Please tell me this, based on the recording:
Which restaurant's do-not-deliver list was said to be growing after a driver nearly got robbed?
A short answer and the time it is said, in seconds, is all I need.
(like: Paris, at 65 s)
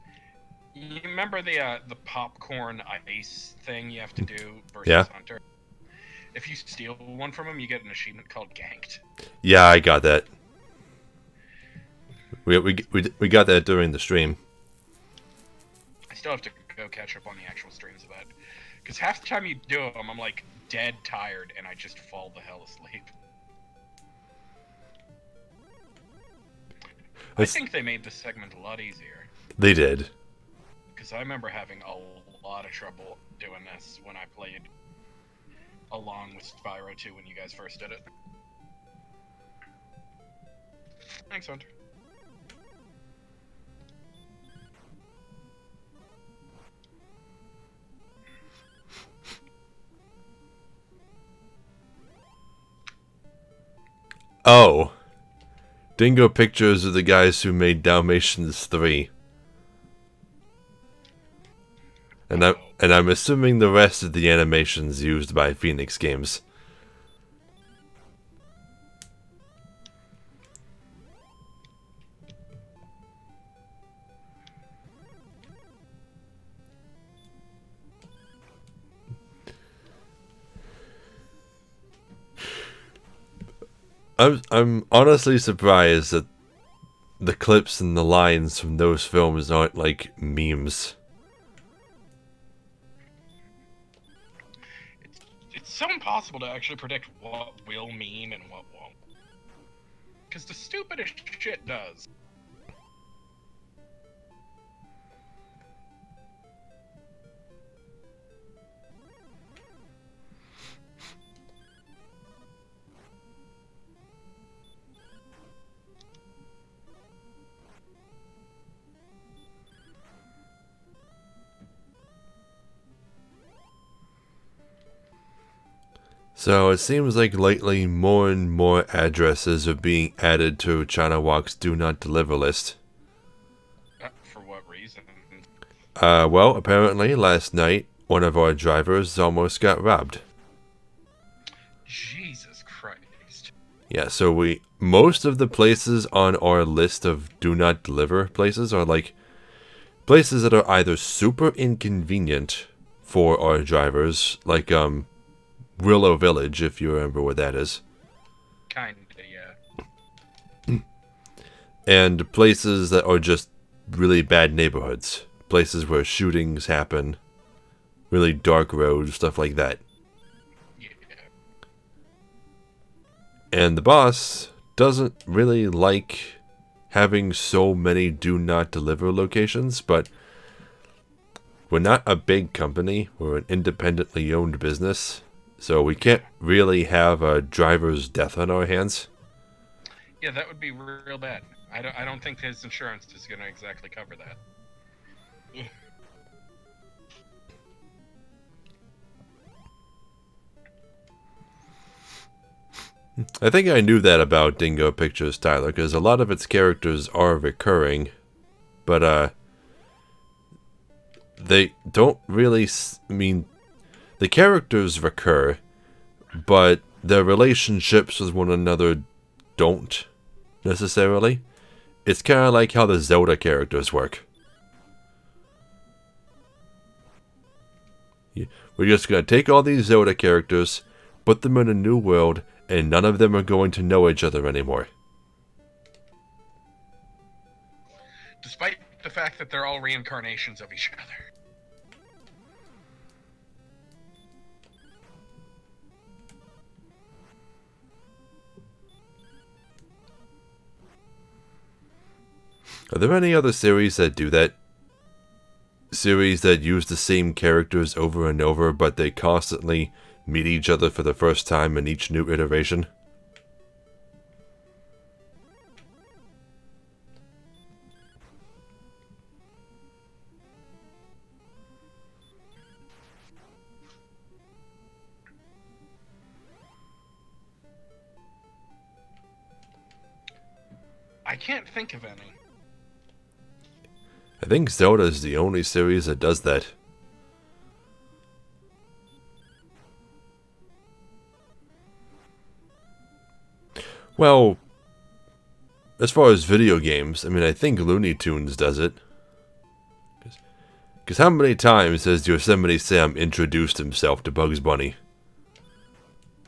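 China Walk, at 130 s.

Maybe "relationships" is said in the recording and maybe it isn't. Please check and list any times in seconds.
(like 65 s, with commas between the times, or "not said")
217 s.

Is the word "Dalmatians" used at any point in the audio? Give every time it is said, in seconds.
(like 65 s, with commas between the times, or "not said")
57 s.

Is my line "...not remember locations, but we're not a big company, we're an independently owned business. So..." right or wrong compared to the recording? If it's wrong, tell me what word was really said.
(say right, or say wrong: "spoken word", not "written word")
wrong: "deliver", not "remember".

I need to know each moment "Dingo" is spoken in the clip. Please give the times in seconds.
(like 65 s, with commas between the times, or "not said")
55 s, 204 s.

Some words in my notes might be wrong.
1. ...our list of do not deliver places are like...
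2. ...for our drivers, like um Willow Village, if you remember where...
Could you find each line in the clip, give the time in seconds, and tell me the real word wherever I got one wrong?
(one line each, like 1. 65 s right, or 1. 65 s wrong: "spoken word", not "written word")
1. 146 s right
2. 153 s right.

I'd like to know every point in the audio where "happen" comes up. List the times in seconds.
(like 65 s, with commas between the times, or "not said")
166 s.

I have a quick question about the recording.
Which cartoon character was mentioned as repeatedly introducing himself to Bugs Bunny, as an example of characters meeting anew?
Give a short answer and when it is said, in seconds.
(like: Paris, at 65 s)
Yosemite Sam, at 302 s.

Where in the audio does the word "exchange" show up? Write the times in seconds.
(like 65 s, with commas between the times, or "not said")
not said.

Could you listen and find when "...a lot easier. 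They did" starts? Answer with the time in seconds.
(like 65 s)
28 s.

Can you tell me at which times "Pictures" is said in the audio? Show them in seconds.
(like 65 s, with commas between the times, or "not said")
56 s, 204 s.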